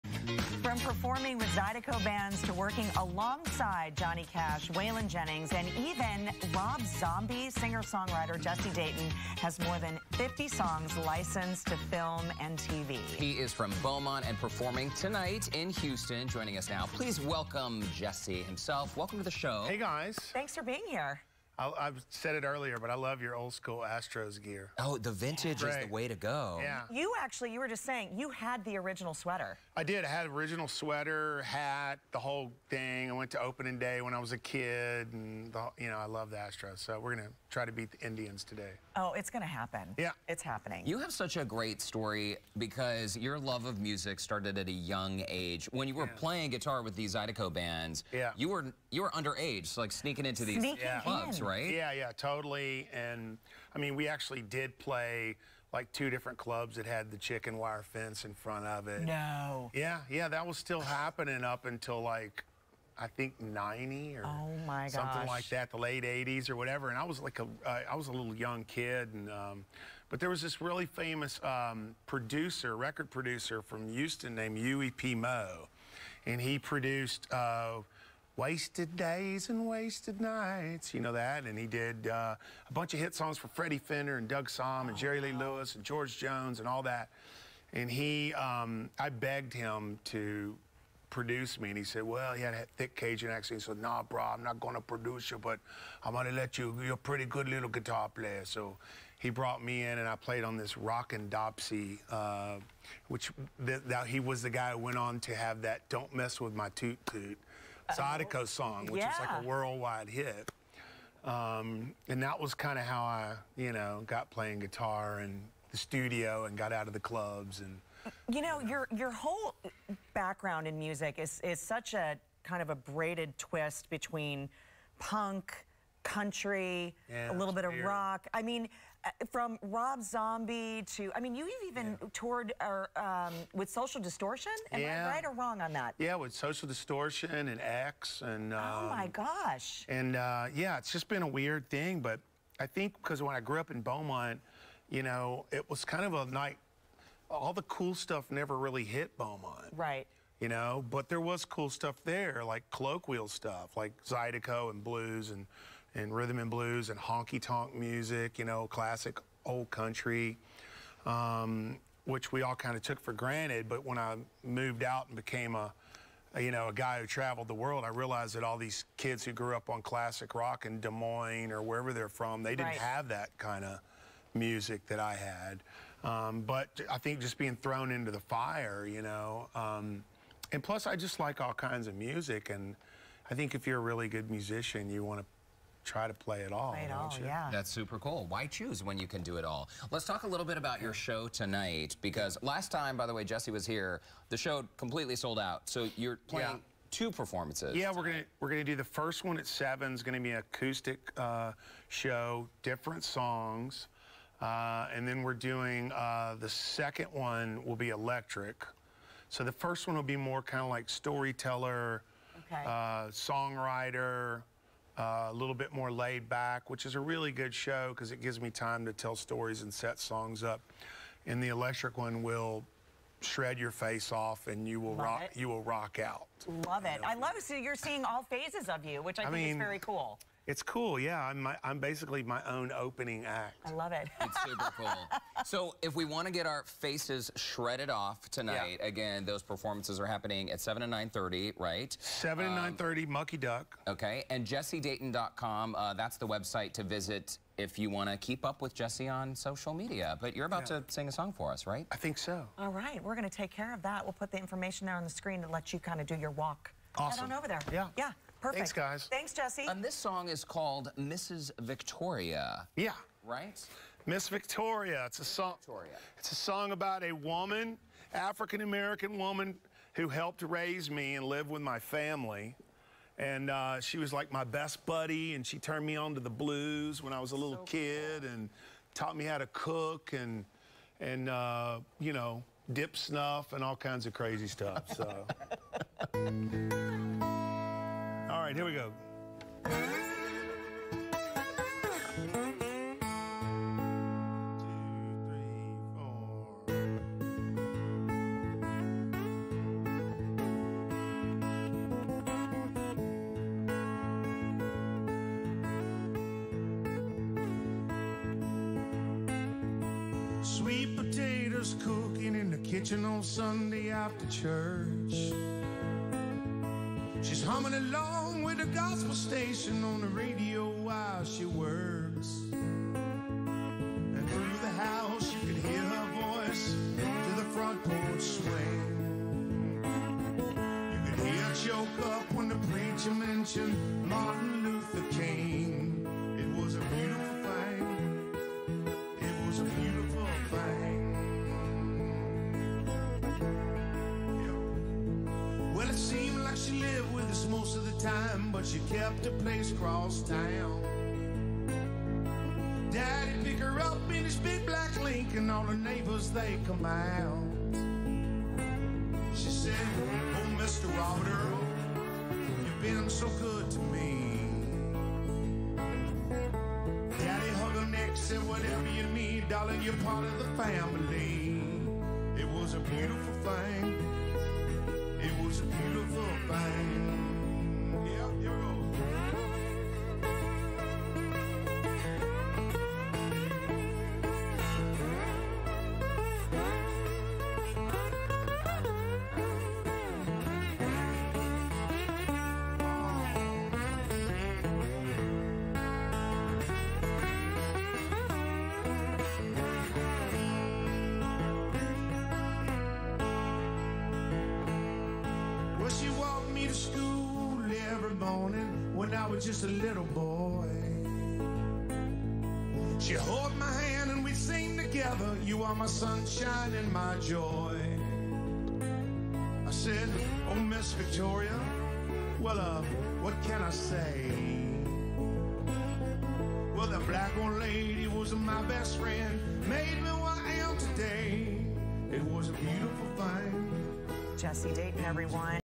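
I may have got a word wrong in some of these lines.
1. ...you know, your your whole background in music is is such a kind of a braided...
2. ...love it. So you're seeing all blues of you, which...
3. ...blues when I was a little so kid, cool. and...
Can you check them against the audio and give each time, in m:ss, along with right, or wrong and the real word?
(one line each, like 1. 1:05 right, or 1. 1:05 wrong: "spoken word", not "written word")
1. 1:58 right
2. 3:47 wrong: "phases", not "blues"
3. 4:36 right.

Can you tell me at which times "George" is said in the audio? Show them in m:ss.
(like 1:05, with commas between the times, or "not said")
1:25.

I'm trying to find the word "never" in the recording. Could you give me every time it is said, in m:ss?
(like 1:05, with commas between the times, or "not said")
2:28.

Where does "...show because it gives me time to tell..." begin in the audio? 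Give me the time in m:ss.
3:37.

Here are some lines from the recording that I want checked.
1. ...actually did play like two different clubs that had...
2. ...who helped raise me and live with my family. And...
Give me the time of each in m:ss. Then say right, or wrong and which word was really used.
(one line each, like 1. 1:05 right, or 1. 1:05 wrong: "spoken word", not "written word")
1. 0:54 right
2. 4:29 right.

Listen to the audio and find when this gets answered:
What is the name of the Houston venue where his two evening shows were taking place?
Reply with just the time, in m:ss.
4:03.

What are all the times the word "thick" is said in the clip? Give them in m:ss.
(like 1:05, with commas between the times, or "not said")
1:32.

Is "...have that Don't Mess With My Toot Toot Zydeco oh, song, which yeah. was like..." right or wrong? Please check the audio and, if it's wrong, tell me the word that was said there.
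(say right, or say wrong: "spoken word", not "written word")
right.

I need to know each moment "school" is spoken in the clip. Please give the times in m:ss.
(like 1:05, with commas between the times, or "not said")
0:23.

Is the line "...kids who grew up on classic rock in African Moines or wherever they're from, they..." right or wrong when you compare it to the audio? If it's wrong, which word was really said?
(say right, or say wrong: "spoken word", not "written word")
wrong: "Des", not "African".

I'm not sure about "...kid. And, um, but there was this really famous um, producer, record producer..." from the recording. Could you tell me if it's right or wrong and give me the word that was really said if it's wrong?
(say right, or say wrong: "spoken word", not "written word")
right.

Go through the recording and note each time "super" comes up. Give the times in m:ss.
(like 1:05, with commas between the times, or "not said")
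3:07, 3:54.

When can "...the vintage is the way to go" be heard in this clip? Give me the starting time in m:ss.
0:24.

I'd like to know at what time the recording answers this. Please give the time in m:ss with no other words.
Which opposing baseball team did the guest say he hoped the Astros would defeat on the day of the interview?
0:38.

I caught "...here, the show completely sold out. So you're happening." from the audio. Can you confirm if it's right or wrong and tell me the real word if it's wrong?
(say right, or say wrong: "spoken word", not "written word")
wrong: "playing", not "happening".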